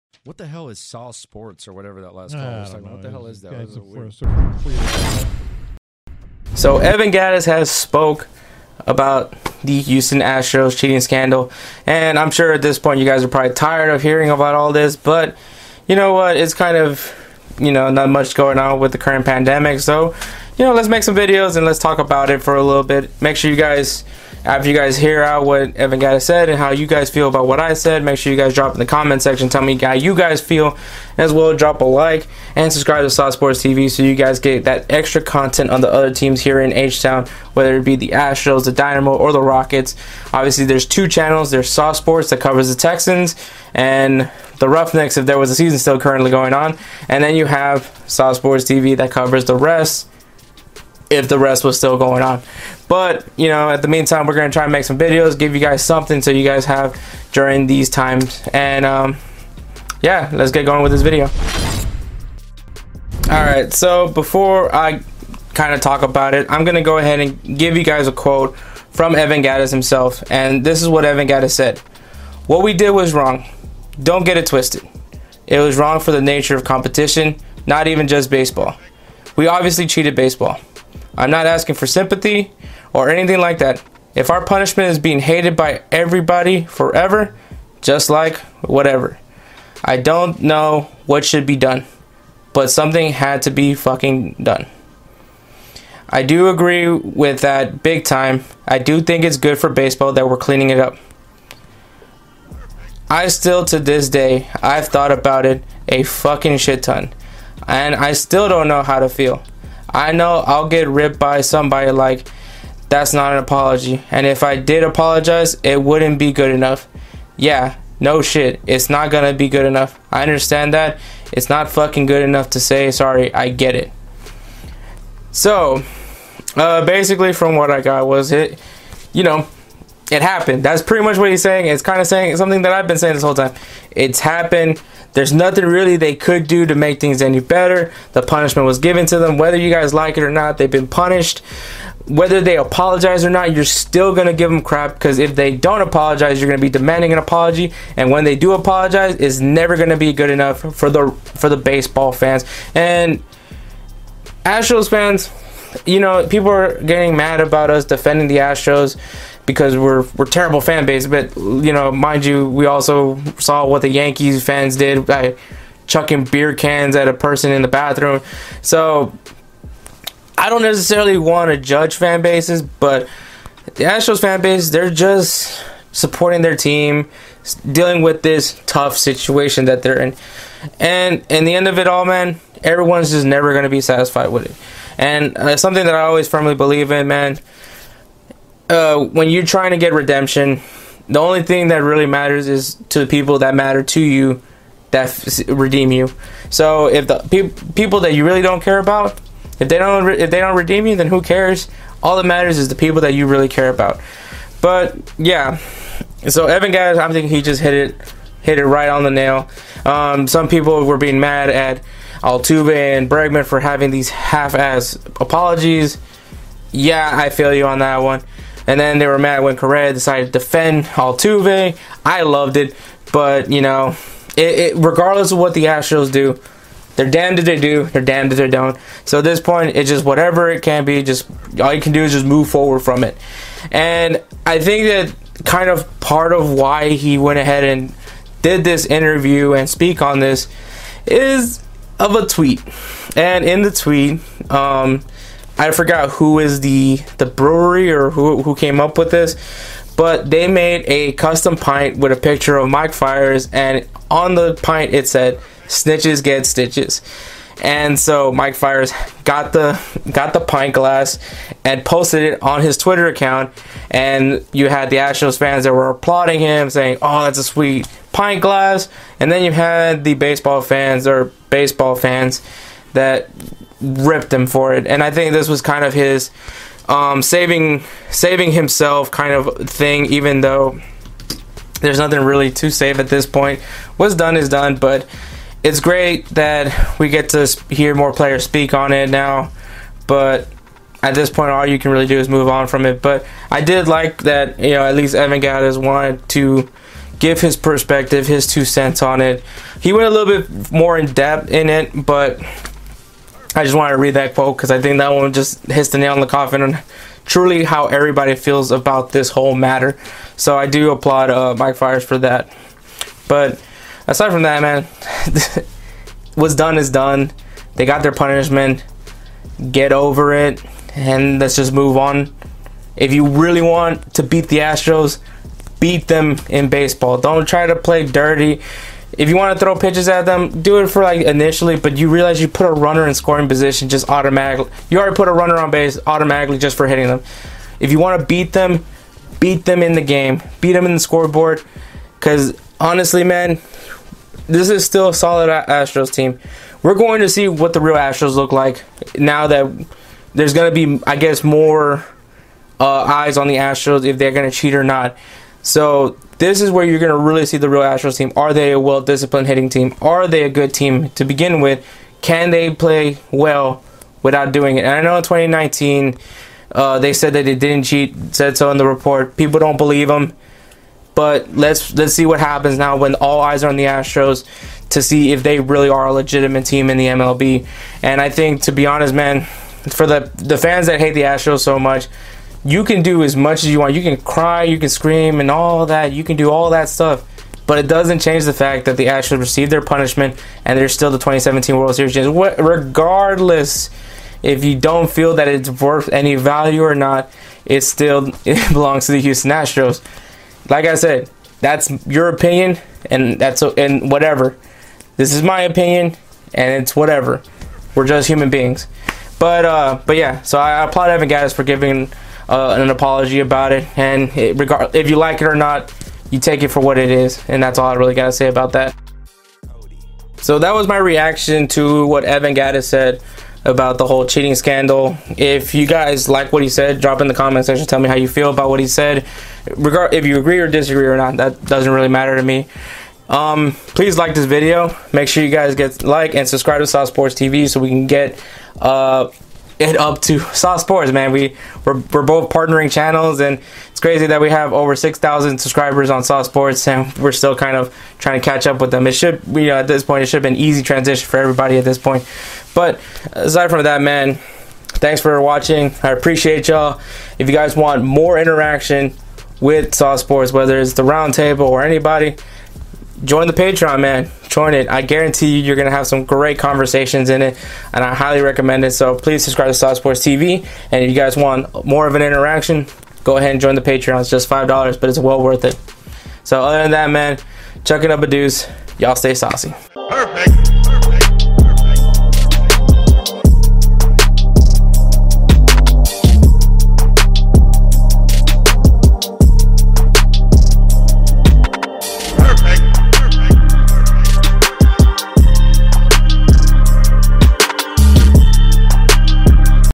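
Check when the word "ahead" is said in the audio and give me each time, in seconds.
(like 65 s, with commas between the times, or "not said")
66 s, 237 s, 473 s.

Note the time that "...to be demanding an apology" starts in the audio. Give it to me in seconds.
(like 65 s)
146 s.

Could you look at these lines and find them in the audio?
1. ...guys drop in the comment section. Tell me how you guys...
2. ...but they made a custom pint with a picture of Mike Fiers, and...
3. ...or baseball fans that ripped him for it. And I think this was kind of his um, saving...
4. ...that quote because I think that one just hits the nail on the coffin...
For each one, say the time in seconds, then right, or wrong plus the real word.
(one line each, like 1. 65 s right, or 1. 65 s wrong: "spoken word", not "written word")
1. 28 s right
2. 249 s right
3. 271 s right
4. 304 s right.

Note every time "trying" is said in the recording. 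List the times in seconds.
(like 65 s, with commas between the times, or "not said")
189 s, 448 s.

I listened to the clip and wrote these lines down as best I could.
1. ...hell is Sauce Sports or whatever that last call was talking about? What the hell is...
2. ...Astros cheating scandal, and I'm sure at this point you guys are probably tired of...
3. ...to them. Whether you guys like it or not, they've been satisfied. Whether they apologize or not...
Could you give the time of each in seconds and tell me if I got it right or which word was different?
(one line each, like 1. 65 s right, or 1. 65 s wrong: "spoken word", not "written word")
1. 0 s right
2. 10 s right
3. 139 s wrong: "punished", not "satisfied".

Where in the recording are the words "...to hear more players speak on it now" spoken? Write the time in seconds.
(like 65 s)
287 s.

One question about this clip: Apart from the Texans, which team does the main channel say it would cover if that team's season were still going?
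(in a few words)
Roughnecks.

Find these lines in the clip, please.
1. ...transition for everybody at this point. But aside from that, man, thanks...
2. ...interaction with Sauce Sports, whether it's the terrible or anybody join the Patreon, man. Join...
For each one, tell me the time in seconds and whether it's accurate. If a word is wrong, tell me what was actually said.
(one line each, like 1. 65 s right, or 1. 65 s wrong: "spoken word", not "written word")
1. 450 s right
2. 458 s wrong: "roundtable", not "terrible".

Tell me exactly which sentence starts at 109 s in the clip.
I know I'll get ripped by somebody like that's not an apology.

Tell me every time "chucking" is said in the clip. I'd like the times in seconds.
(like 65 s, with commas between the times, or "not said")
165 s, 477 s.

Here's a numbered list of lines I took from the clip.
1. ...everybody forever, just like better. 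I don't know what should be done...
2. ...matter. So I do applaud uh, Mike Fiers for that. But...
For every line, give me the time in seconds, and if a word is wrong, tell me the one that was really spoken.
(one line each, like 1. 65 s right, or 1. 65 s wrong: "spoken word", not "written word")
1. 85 s wrong: "whatever", not "better"
2. 309 s right.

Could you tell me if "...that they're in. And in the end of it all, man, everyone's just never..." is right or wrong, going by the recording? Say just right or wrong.
right.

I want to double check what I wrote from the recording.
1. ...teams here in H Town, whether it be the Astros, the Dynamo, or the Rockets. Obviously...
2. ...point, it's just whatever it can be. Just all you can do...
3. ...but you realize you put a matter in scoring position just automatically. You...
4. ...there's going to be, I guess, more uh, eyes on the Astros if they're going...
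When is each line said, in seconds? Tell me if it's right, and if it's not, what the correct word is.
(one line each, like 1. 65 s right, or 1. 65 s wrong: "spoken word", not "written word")
1. 36 s right
2. 229 s right
3. 331 s wrong: "runner", not "matter"
4. 350 s right.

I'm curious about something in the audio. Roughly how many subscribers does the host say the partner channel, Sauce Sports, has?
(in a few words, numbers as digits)
6,000.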